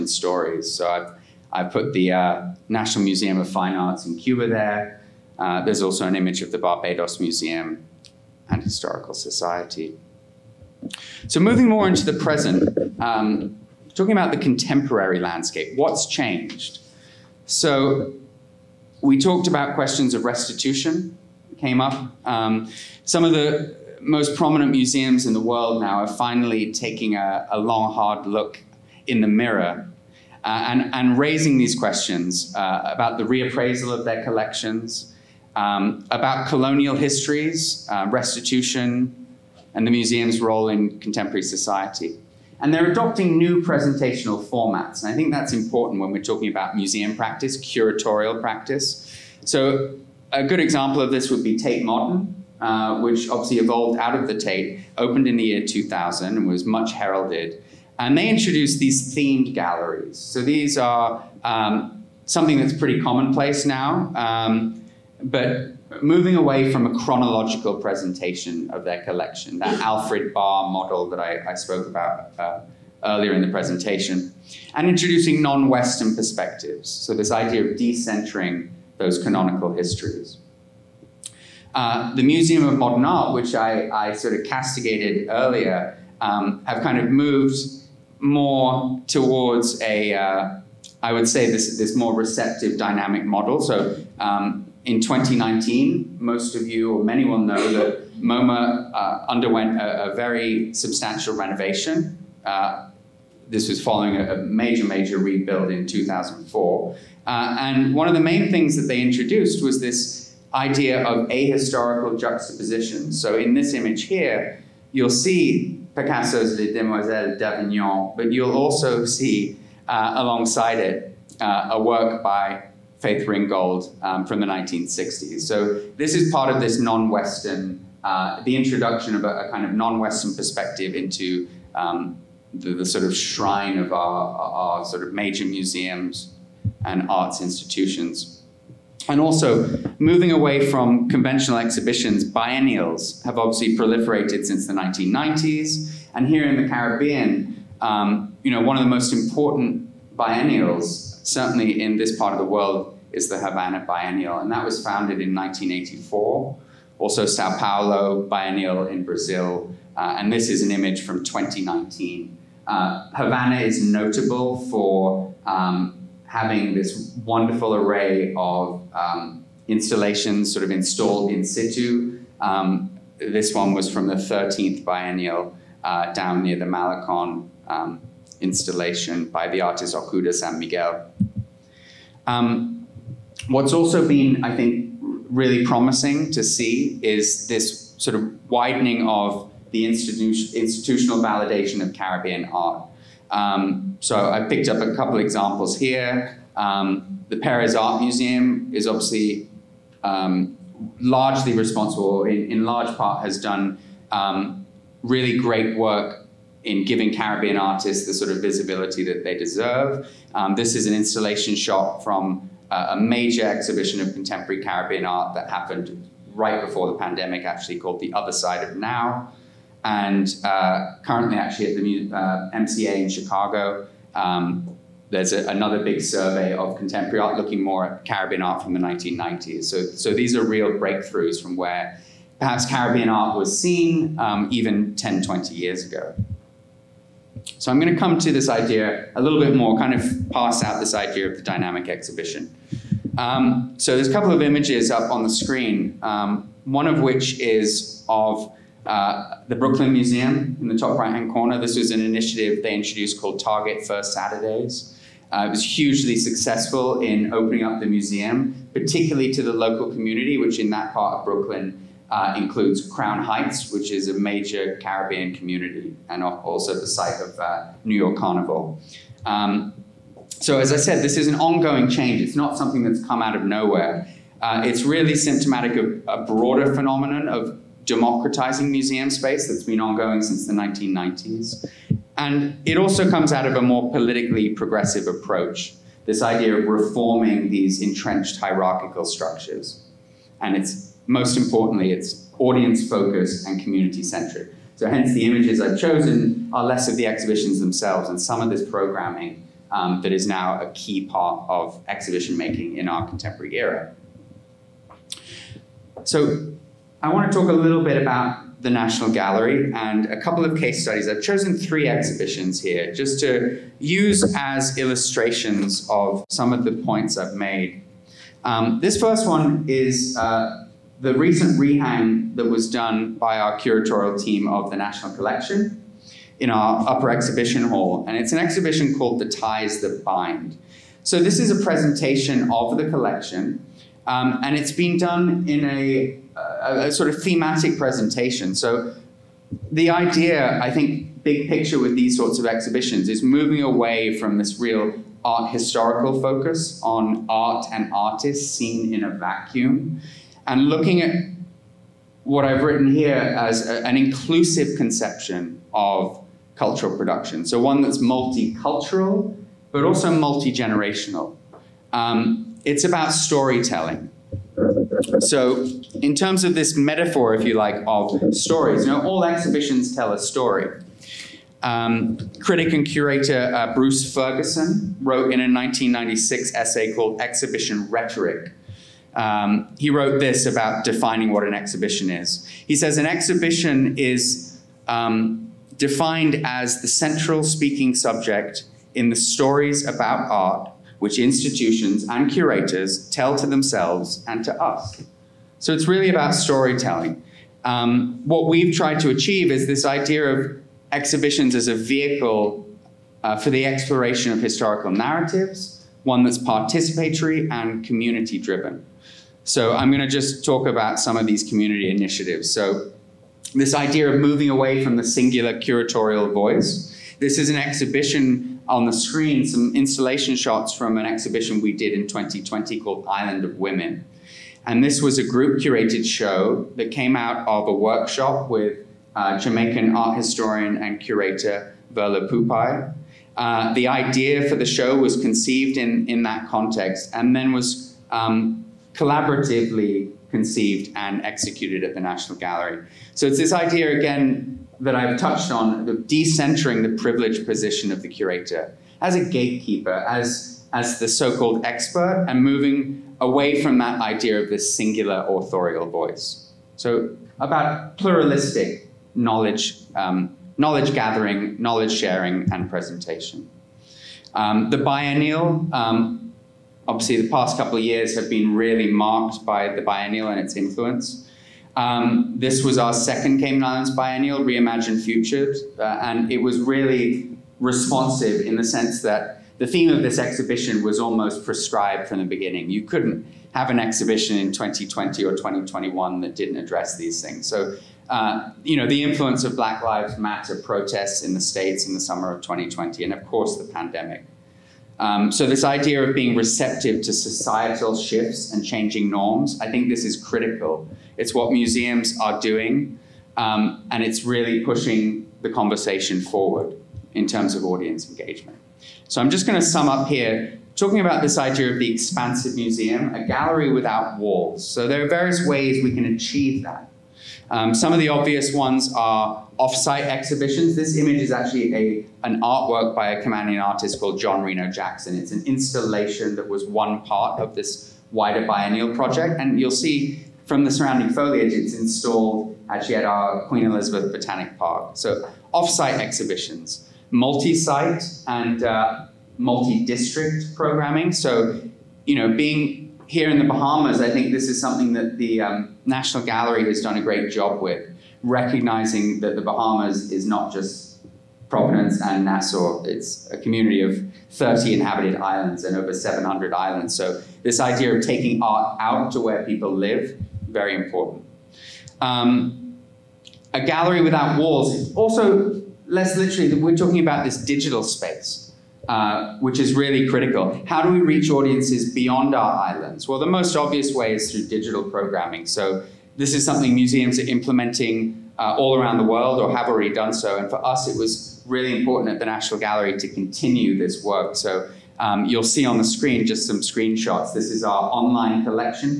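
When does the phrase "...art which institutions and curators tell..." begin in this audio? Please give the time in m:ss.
6:30.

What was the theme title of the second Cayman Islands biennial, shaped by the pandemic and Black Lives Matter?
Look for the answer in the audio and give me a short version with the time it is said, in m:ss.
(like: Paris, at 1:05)
Reimagined Futures, at 7:54.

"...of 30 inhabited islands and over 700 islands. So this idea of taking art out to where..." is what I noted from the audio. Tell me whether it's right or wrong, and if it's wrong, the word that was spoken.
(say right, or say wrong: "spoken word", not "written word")
right.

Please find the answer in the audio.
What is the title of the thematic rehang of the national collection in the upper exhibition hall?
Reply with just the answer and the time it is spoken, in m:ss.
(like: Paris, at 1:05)
The Ties That Bind, at 5:29.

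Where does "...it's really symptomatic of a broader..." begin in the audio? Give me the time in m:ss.
4:34.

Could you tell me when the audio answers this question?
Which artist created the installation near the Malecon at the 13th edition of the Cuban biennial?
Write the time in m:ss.
2:59.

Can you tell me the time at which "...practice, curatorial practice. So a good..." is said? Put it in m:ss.
0:47.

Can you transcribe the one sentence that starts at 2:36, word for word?
Also, Sao Paulo Biennial in Brazil, uh, and this is an image from 2019.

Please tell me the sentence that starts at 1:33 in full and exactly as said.
So um, in 2019, most of you or many will know that MoMA uh, underwent a, a, very substantial renovation.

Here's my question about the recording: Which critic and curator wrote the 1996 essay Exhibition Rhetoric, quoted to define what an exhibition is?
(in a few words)
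Bruce Ferguson.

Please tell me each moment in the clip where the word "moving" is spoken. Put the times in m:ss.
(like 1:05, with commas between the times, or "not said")
0:11, 1:06, 2:19, 5:43, 6:54, 7:32.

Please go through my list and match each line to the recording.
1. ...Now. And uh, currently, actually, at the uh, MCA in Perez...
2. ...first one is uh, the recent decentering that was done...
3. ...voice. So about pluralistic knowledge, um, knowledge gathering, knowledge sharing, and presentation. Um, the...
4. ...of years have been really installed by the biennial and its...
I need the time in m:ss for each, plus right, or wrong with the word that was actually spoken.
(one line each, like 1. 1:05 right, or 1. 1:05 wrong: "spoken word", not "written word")
1. 3:38 wrong: "Chicago", not "Perez"
2. 5:18 wrong: "rehang", not "decentering"
3. 7:35 right
4. 7:47 wrong: "marked", not "installed".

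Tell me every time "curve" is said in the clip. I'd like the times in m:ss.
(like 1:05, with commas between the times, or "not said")
not said.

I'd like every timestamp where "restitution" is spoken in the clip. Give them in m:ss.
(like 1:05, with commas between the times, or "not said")
0:20, 0:38.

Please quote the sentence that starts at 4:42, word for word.
And it also comes out of a more politically progressive approach, this idea of reforming these entrenched hierarchical structures.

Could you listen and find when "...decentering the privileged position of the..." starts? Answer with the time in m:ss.
7:25.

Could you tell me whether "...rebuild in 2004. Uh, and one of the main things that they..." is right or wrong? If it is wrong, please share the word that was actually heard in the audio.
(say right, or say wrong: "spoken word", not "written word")
right.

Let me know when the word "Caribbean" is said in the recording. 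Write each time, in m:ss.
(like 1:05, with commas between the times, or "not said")
2:26, 3:11, 3:27, 3:34, 3:48, 3:52, 4:24.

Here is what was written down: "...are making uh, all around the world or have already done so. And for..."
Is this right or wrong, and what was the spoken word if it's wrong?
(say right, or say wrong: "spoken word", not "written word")
wrong: "implementing", not "making".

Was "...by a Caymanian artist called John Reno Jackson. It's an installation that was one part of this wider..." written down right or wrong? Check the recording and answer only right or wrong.
right.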